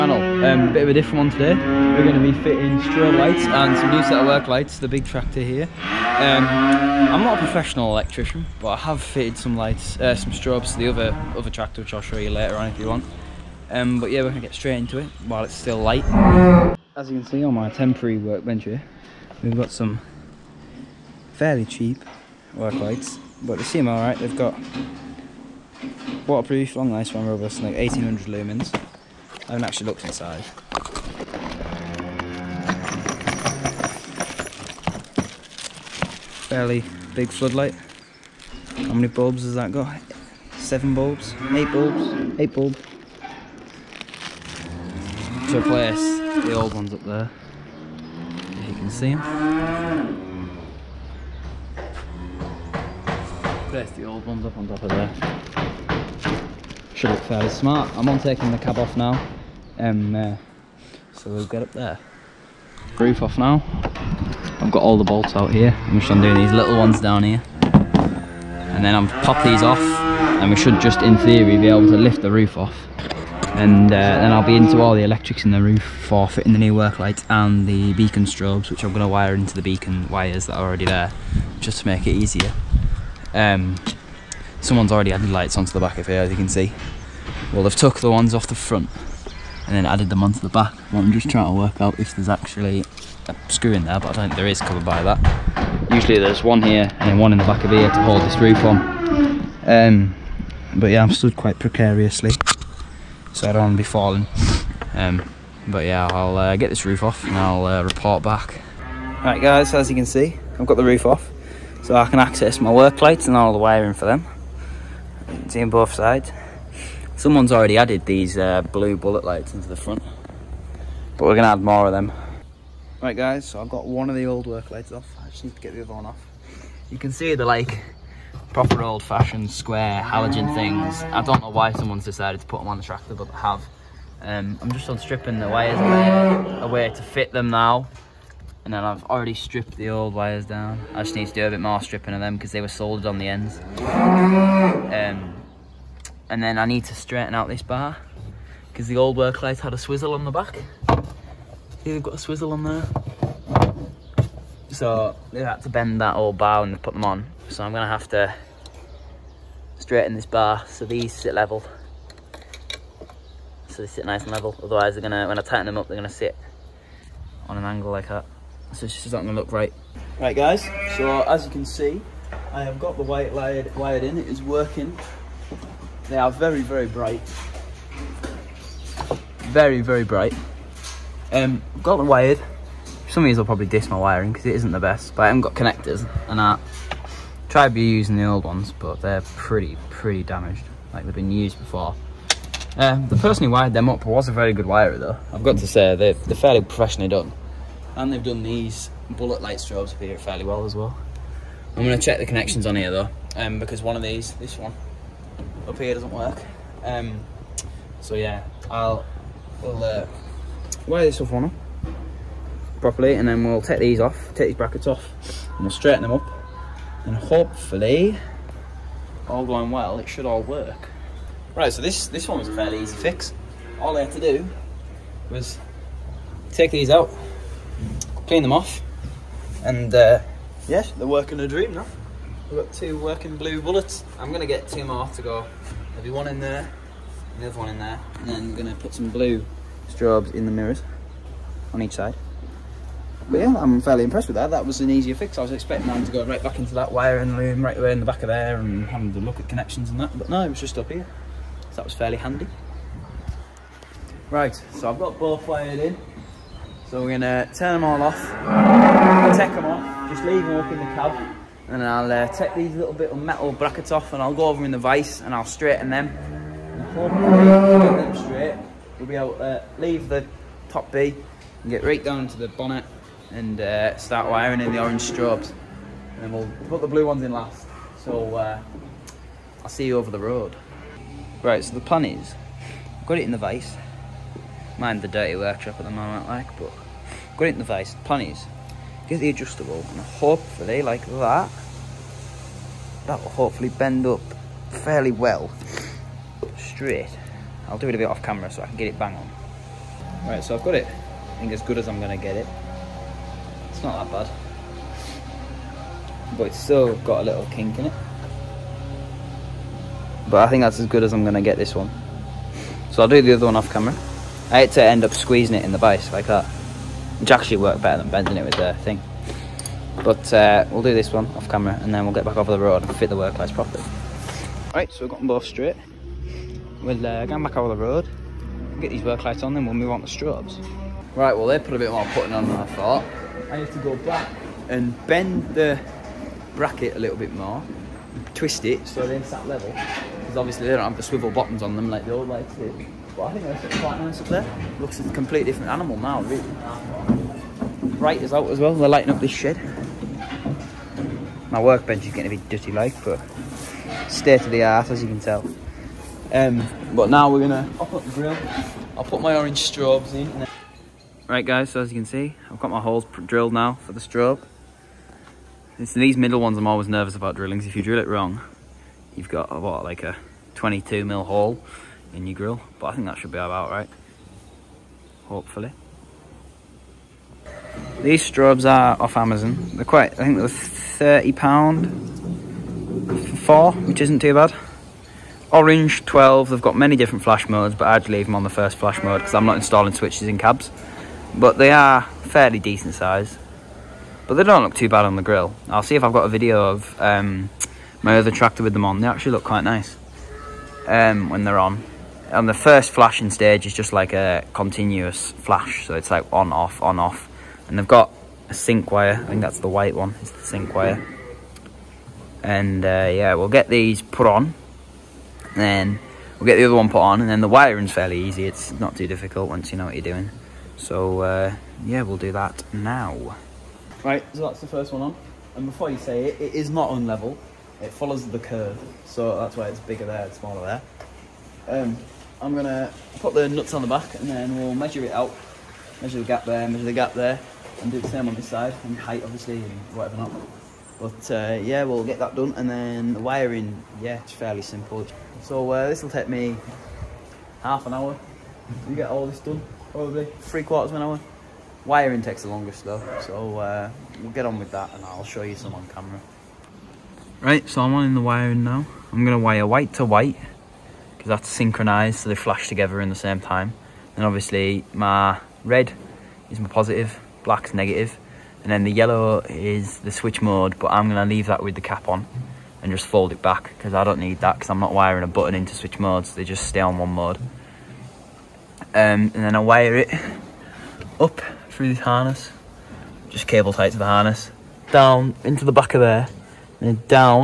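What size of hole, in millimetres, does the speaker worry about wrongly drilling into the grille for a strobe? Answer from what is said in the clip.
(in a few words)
22 mm.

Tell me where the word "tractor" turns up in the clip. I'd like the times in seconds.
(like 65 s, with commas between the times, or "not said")
5 s, 11 s, 132 s, 398 s.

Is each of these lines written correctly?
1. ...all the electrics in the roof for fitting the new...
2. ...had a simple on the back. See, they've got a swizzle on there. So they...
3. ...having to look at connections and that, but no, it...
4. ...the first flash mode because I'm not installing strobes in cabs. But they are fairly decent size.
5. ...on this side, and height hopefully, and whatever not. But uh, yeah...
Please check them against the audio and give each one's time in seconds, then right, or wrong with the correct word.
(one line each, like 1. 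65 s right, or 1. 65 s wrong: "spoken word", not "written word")
1. 74 s right
2. 149 s wrong: "swizzle", not "simple"
3. 248 s right
4. 388 s wrong: "switches", not "strobes"
5. 438 s wrong: "obviously", not "hopefully".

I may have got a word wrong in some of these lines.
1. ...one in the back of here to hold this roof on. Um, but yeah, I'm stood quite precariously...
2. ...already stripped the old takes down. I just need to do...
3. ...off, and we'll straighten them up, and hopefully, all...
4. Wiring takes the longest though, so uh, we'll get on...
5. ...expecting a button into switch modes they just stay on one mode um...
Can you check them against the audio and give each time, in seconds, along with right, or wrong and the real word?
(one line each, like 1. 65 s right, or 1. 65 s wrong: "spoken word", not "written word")
1. 97 s right
2. 139 s wrong: "wires", not "takes"
3. 214 s right
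4. 451 s right
5. 474 s wrong: "wiring", not "expecting".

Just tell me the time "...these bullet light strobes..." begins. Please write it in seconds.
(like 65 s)
198 s.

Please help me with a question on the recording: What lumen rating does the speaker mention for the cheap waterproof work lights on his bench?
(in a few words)
1800.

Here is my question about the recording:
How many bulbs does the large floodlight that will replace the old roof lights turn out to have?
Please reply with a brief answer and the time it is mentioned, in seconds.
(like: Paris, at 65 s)
8, at 42 s.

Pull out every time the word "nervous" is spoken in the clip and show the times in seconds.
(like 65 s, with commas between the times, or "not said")
366 s.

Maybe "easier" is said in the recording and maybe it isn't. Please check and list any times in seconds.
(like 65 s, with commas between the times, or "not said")
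82 s, 244 s.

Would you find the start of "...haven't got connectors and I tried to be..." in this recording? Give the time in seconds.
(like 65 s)
185 s.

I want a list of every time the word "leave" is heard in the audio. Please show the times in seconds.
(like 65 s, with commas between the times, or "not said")
260 s, 269 s, 388 s, 471 s.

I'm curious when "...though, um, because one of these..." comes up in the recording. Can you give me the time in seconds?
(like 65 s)
202 s.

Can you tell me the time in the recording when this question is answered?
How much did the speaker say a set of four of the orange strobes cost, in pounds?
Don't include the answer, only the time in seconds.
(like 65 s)
380 s.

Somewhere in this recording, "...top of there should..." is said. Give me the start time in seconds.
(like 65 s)
54 s.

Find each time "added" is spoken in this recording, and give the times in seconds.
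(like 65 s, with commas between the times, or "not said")
85 s, 89 s, 117 s.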